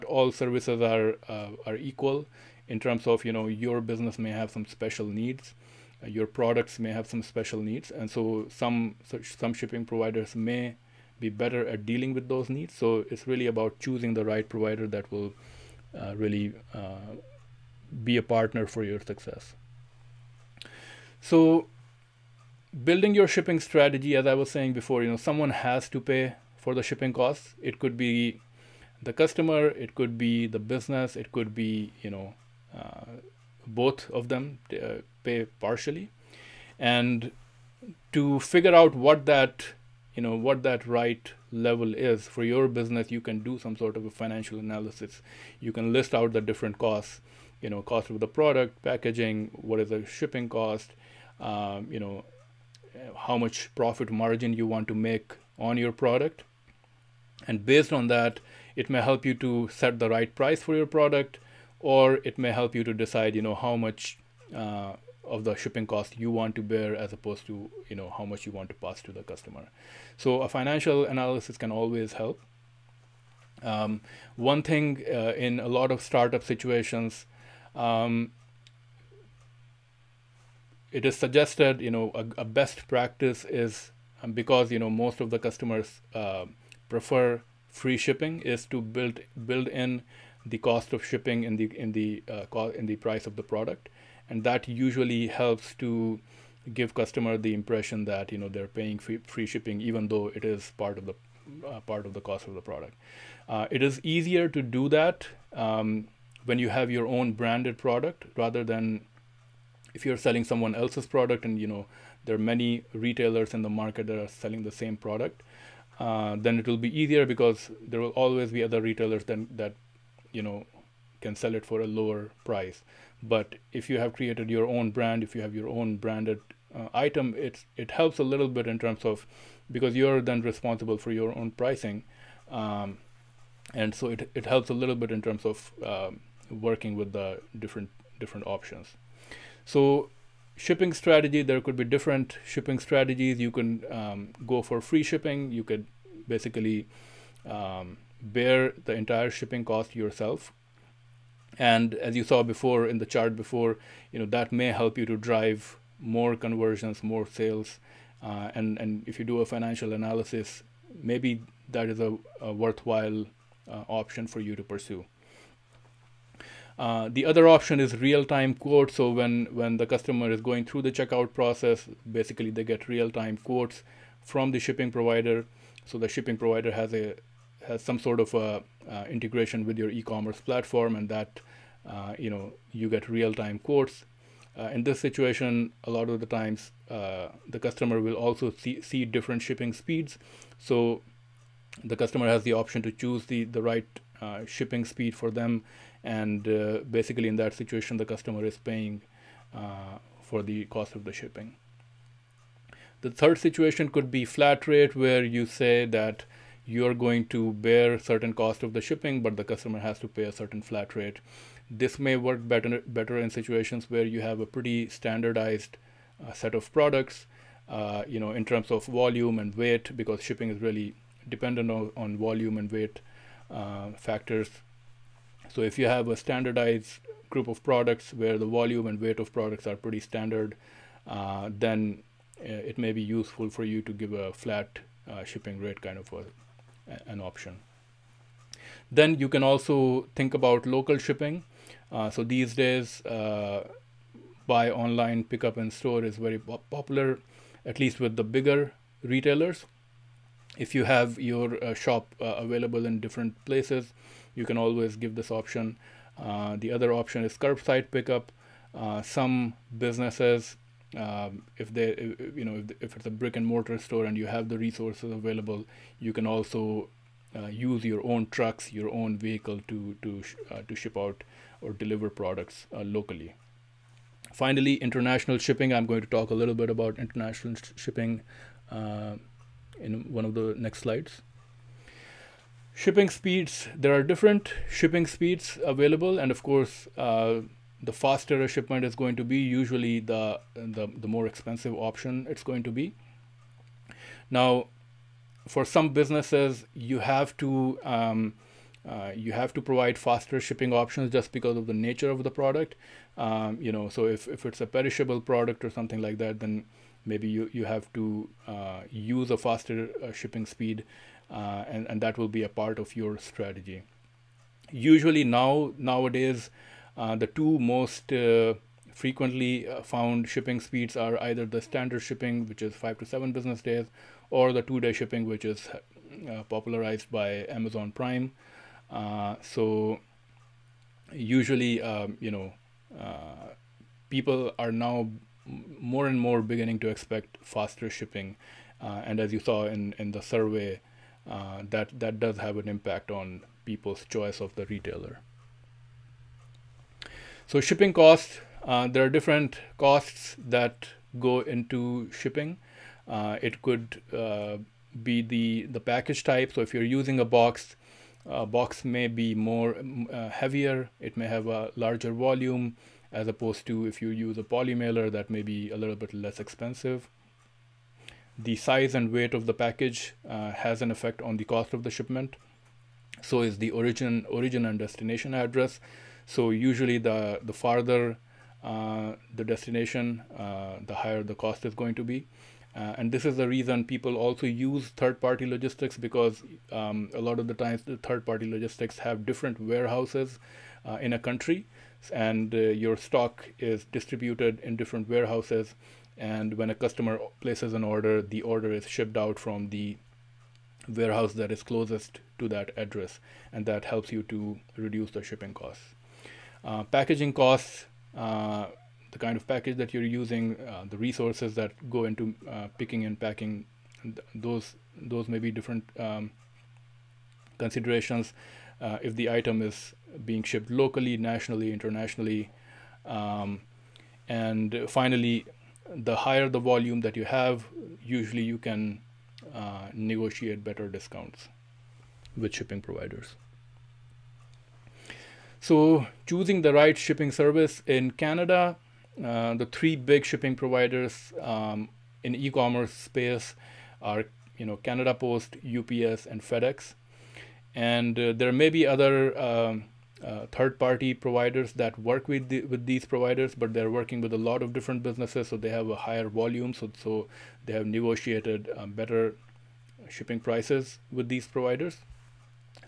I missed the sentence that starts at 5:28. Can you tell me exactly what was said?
Uh, so usually, um, you know, people are now more and more beginning to expect faster shipping.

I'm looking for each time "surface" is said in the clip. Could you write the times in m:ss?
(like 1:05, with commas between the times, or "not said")
not said.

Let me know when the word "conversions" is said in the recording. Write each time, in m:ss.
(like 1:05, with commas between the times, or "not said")
2:36.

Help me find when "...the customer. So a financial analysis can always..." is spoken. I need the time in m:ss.
1:09.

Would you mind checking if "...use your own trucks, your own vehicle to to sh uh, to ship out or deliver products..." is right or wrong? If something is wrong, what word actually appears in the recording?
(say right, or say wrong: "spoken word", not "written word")
right.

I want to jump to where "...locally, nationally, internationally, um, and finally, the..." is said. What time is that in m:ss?
7:00.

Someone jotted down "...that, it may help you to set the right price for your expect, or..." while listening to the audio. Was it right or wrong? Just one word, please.
wrong.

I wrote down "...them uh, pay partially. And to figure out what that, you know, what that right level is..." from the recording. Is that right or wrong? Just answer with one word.
right.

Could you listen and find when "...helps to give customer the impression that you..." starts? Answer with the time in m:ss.
1:35.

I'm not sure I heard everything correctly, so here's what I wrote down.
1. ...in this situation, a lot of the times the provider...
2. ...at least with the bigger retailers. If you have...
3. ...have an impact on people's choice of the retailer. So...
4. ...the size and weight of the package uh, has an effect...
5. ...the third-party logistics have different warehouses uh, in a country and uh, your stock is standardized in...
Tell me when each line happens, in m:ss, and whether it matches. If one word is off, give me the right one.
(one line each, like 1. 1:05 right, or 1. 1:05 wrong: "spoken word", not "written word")
1. 3:04 wrong: "customer", not "provider"
2. 4:07 right
3. 5:42 right
4. 6:08 right
5. 6:27 wrong: "distributed", not "standardized".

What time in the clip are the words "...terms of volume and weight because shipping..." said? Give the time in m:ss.
3:38.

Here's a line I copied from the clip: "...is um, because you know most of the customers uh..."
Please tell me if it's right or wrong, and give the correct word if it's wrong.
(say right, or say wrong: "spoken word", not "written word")
right.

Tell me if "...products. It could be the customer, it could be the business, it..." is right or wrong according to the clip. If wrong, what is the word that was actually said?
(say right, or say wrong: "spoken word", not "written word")
wrong: "costs", not "products".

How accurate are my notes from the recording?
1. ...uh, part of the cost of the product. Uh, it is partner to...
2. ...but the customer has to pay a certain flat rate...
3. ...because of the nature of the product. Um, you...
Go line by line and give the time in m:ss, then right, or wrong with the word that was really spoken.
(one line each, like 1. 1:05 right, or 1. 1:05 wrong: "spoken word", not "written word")
1. 1:41 wrong: "easier", not "partner"
2. 3:29 right
3. 5:01 right.